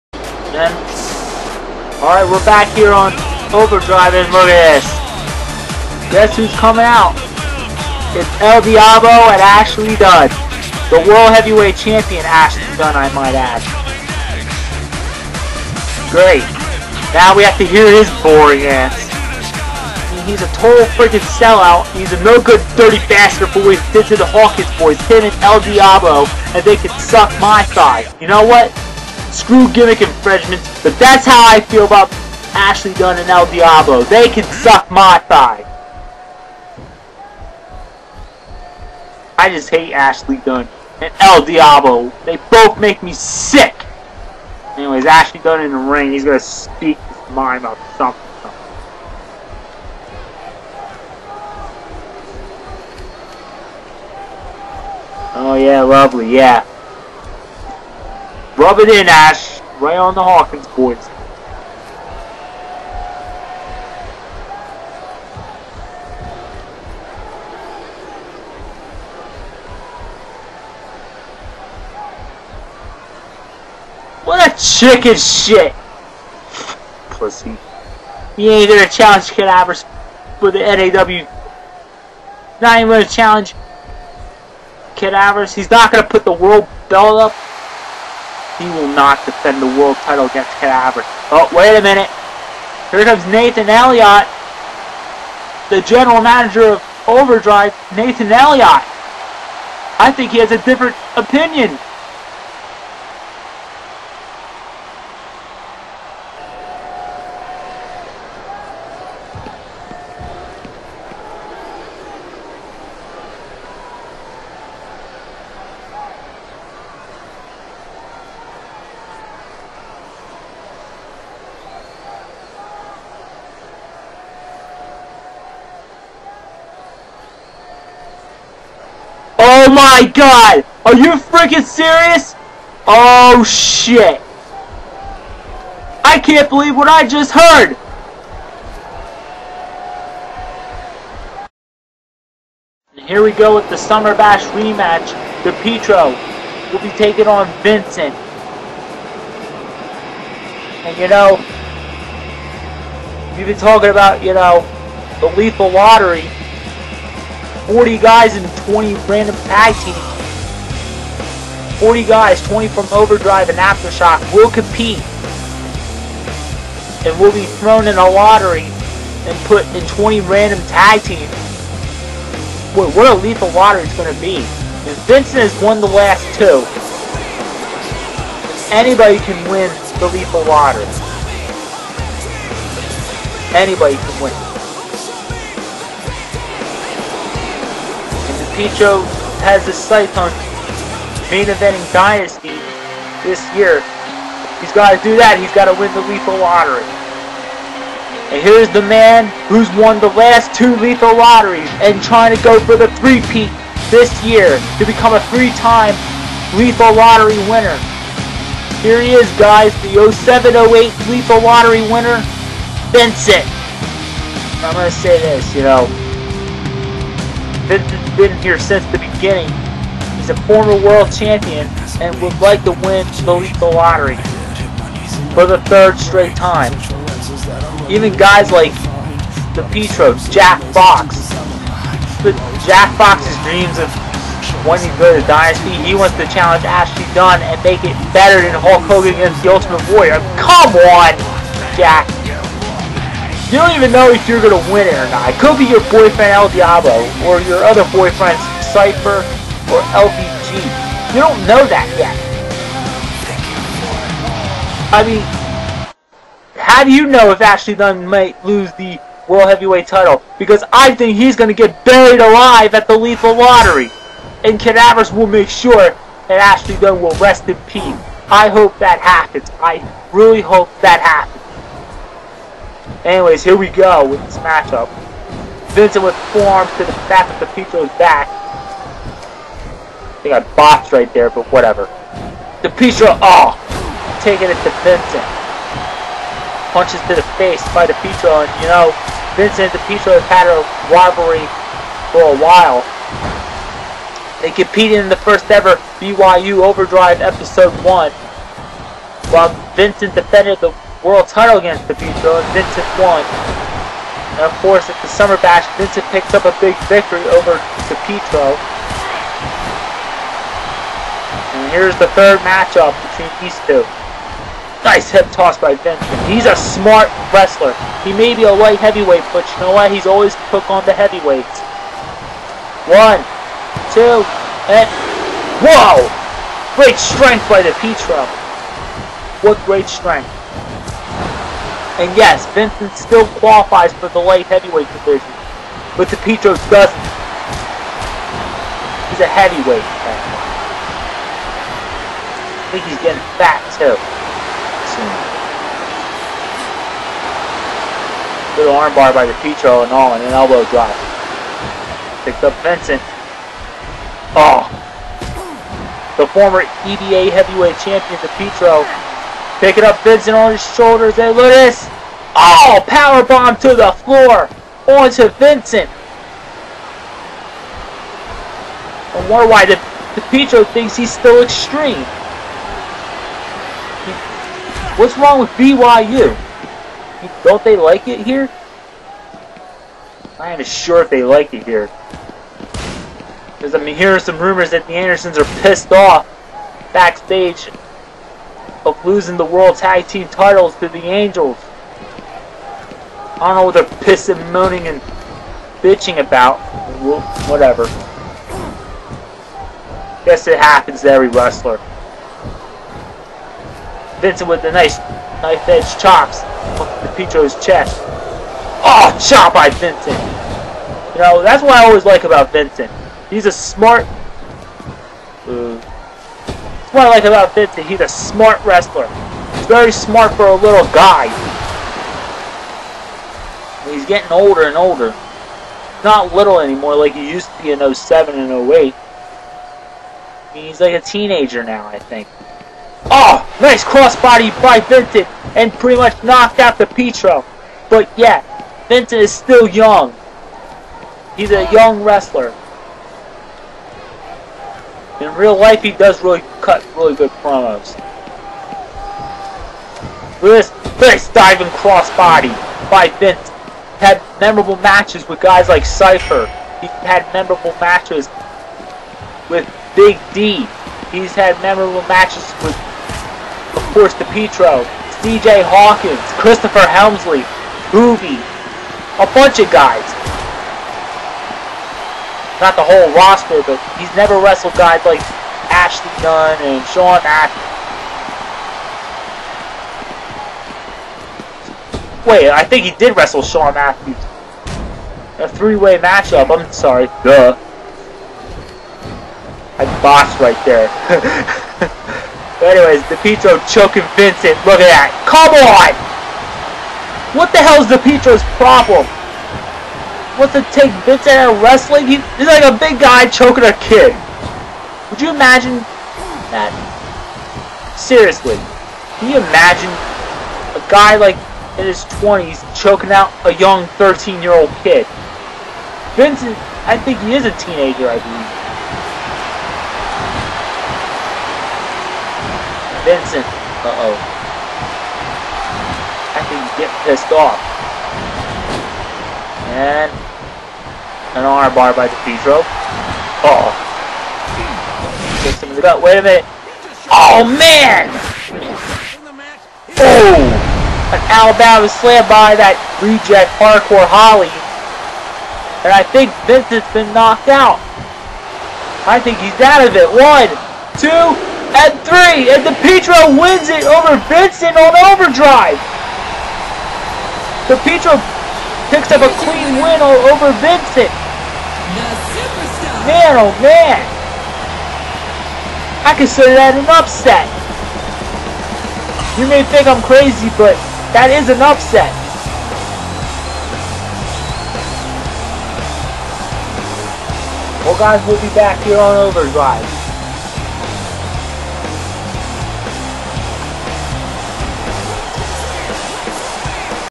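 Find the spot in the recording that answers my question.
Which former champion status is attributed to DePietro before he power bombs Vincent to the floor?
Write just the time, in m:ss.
5:56.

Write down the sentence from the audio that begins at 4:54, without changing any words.
They competed in the first ever BYU Overdrive Episode 1, while Vincent defended the world title against Pedrito and Vincent won.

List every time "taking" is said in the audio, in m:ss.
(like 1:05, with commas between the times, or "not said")
2:26, 4:44.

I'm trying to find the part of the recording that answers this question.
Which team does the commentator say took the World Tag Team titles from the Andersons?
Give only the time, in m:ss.
6:30.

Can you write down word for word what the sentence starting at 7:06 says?
Not little anymore like he used to be in 07 and 08.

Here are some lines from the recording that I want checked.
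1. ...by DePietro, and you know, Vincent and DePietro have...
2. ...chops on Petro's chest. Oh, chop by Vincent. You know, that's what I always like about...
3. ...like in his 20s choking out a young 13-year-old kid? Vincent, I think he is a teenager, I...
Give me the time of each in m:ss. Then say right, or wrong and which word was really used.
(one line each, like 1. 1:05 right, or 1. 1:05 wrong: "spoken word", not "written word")
1. 4:47 right
2. 6:45 right
3. 8:31 right.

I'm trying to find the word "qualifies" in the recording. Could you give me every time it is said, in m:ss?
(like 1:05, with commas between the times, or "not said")
5:33.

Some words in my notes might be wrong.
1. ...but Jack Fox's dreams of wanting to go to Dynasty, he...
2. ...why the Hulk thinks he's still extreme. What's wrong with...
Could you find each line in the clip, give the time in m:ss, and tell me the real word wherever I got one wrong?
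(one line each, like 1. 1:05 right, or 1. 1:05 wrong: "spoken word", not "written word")
1. 3:52 right
2. 6:09 wrong: "DePietro", not "Hulk".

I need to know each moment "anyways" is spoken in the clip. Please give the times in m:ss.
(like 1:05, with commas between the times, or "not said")
0:44, 4:33, 8:12.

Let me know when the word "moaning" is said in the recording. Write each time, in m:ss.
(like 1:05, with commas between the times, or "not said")
6:34.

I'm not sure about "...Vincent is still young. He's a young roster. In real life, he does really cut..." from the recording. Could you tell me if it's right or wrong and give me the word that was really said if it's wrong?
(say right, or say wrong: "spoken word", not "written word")
wrong: "wrestler", not "roster".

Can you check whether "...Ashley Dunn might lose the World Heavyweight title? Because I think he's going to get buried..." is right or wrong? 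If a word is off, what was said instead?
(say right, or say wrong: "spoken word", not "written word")
right.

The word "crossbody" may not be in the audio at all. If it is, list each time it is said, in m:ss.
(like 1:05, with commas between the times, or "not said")
7:13, 7:31.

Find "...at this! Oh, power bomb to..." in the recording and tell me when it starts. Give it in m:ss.
6:01.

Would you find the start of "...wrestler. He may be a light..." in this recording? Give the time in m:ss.
5:17.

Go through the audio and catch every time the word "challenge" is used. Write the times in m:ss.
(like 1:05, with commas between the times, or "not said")
1:18, 1:23, 3:56.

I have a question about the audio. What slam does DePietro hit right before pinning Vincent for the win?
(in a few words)
Alabama slam.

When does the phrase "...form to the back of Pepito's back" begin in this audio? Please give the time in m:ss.
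4:36.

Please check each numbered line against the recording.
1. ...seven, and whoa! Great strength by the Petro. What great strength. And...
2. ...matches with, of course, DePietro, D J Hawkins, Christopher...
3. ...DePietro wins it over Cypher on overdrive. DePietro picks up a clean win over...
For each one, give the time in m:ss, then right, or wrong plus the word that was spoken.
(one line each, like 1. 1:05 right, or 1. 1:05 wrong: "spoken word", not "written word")
1. 5:23 wrong: "two", not "seven"
2. 7:42 right
3. 9:12 wrong: "Vincent", not "Cypher".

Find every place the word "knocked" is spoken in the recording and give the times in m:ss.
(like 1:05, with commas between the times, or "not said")
7:16, 9:07.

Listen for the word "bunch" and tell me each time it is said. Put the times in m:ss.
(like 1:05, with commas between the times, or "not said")
7:49.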